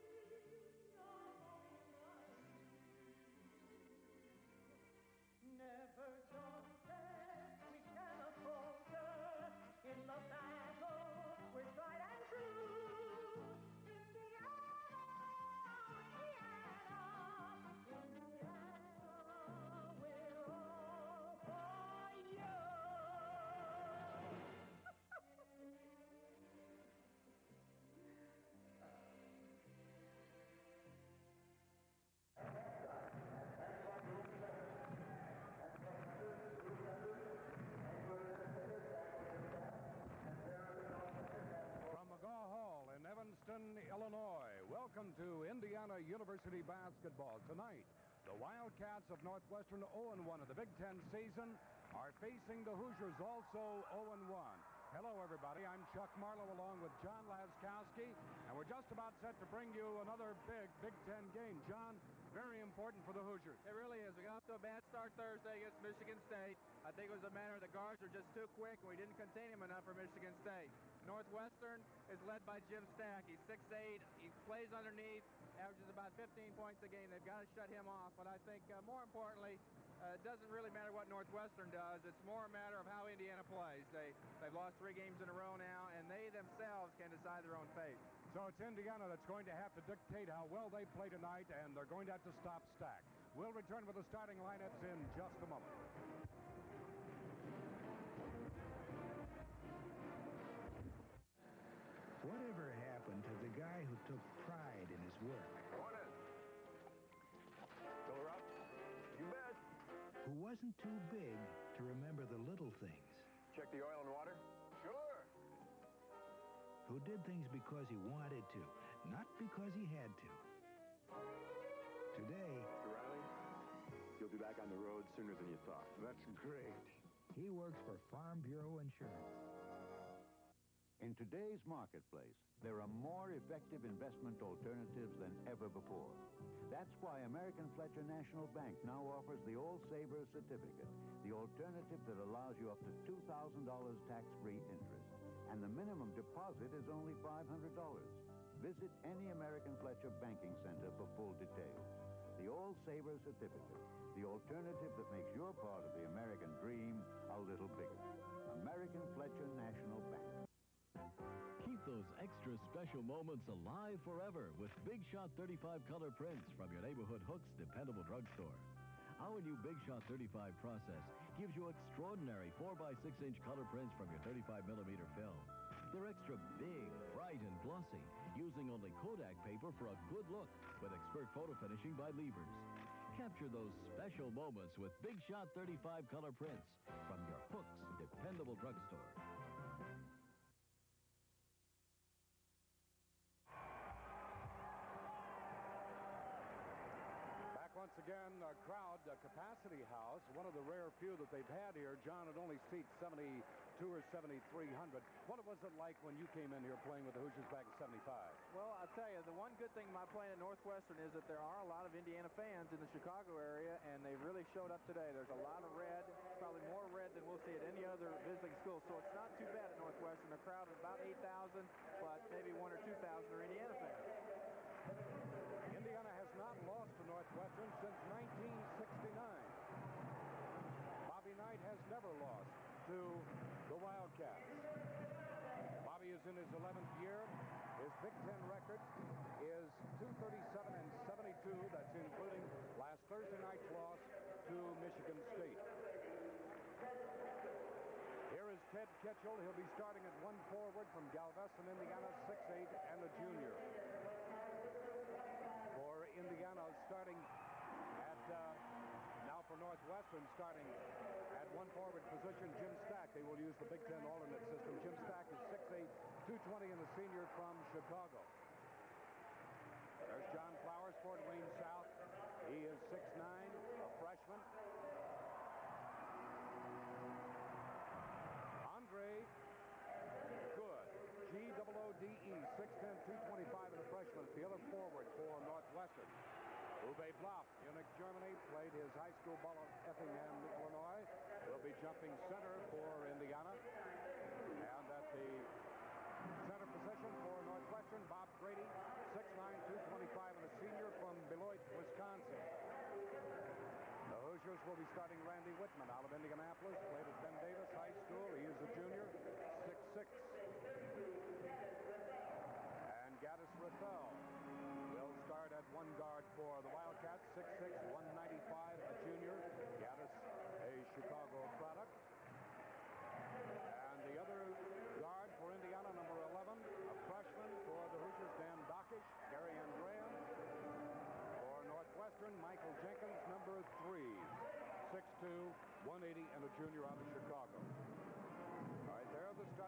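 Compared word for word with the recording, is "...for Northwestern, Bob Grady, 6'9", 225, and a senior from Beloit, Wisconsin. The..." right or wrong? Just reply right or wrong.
right.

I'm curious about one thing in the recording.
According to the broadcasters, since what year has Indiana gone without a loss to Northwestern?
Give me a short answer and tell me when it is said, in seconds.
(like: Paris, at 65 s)
1969, at 228 s.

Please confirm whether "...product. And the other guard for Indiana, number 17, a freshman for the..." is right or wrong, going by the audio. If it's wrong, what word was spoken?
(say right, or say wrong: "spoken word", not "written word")
wrong: "11", not "17".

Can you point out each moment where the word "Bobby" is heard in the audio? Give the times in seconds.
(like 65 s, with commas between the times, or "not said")
231 s, 235 s.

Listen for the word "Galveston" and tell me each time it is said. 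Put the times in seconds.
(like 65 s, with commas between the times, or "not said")
251 s.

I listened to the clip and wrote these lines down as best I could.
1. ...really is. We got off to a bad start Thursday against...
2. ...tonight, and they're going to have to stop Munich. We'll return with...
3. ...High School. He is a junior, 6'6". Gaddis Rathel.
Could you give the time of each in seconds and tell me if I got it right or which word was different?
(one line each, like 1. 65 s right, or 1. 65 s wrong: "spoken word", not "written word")
1. 63 s right
2. 91 s wrong: "Stack", not "Munich"
3. 307 s right.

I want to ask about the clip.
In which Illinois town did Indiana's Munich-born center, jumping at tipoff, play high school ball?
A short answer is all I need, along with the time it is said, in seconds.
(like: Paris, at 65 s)
Effingham, Illinois, at 289 s.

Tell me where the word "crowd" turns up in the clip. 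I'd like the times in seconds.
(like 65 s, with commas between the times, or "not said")
198 s, 220 s.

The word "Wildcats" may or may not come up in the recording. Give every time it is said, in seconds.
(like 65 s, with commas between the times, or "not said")
48 s, 233 s, 316 s.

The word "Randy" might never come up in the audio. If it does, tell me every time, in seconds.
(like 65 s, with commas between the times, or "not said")
305 s.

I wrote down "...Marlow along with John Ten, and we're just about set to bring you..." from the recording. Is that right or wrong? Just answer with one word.
wrong.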